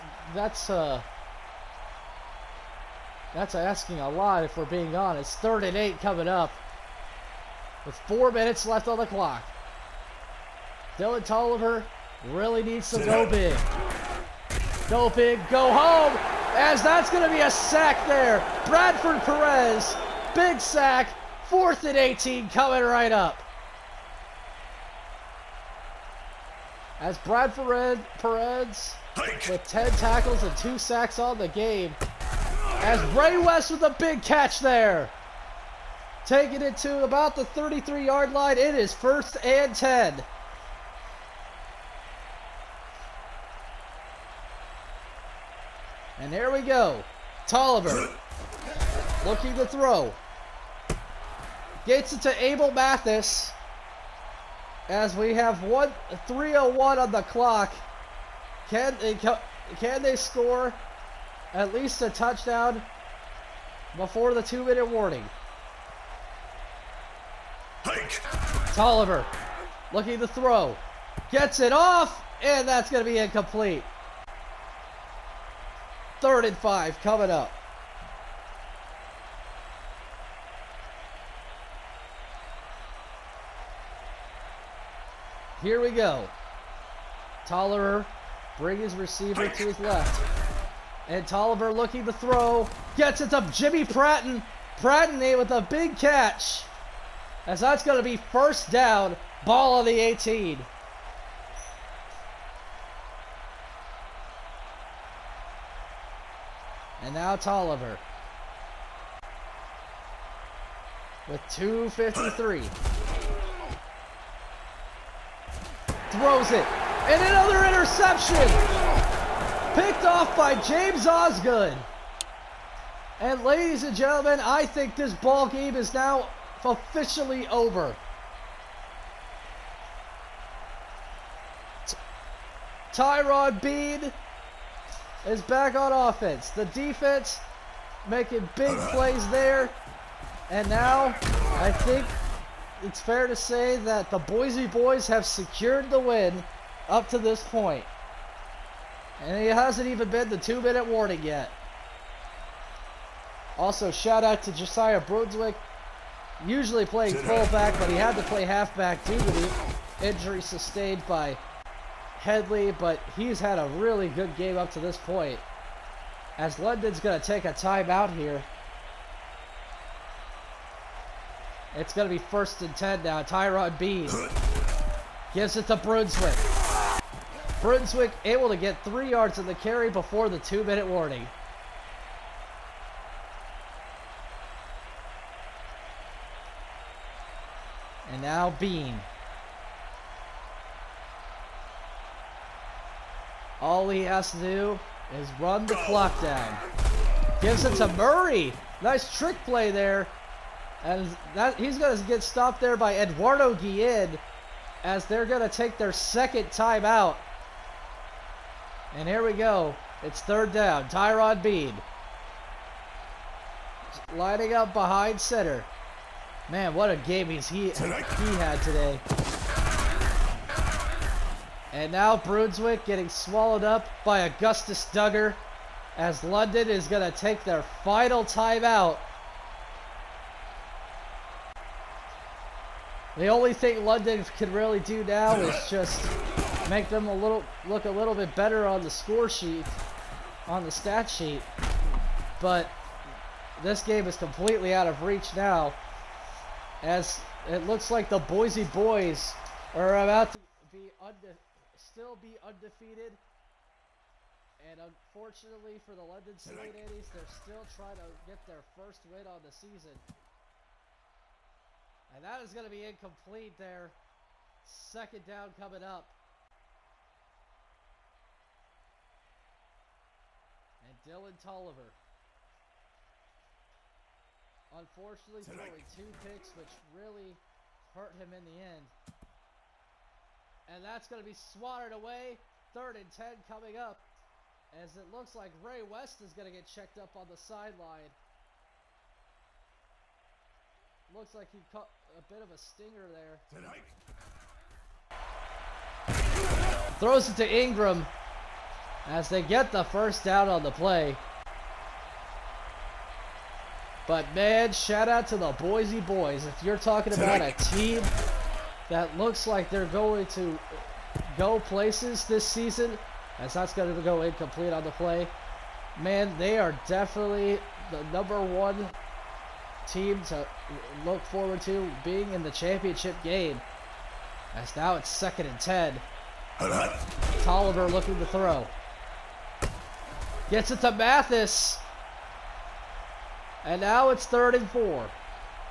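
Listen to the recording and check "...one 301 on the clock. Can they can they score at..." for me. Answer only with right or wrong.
right.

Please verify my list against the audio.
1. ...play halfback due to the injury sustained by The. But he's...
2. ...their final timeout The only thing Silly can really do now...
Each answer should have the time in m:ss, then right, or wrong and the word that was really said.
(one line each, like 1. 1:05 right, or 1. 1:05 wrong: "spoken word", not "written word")
1. 2:38 wrong: "Headley", not "The"
2. 3:47 wrong: "London", not "Silly".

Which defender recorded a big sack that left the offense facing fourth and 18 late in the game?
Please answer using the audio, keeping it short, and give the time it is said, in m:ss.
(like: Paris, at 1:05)
Bradford Perez, at 0:18.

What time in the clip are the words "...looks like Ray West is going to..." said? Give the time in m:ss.
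4:45.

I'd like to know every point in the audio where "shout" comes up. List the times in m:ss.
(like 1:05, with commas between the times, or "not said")
2:33, 5:04.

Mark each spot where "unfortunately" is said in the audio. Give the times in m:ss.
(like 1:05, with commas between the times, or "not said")
4:14, 4:34.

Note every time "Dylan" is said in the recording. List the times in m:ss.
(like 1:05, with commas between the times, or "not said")
0:10, 4:31.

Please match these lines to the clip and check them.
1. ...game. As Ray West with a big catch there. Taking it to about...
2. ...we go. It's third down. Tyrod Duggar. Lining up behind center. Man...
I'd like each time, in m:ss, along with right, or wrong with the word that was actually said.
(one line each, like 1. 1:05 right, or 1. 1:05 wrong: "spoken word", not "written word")
1. 0:31 right
2. 3:29 wrong: "Bean", not "Duggar".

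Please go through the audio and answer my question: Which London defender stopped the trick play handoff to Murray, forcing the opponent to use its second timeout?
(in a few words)
Eduardo Guillen.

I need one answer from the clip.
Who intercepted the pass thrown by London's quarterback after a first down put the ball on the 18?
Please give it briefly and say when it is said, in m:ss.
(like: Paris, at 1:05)
James Osgood, at 2:00.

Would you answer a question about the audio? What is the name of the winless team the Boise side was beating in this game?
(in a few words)
London Silly Nannies.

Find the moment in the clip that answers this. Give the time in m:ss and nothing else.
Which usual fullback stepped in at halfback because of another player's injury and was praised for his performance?
2:34.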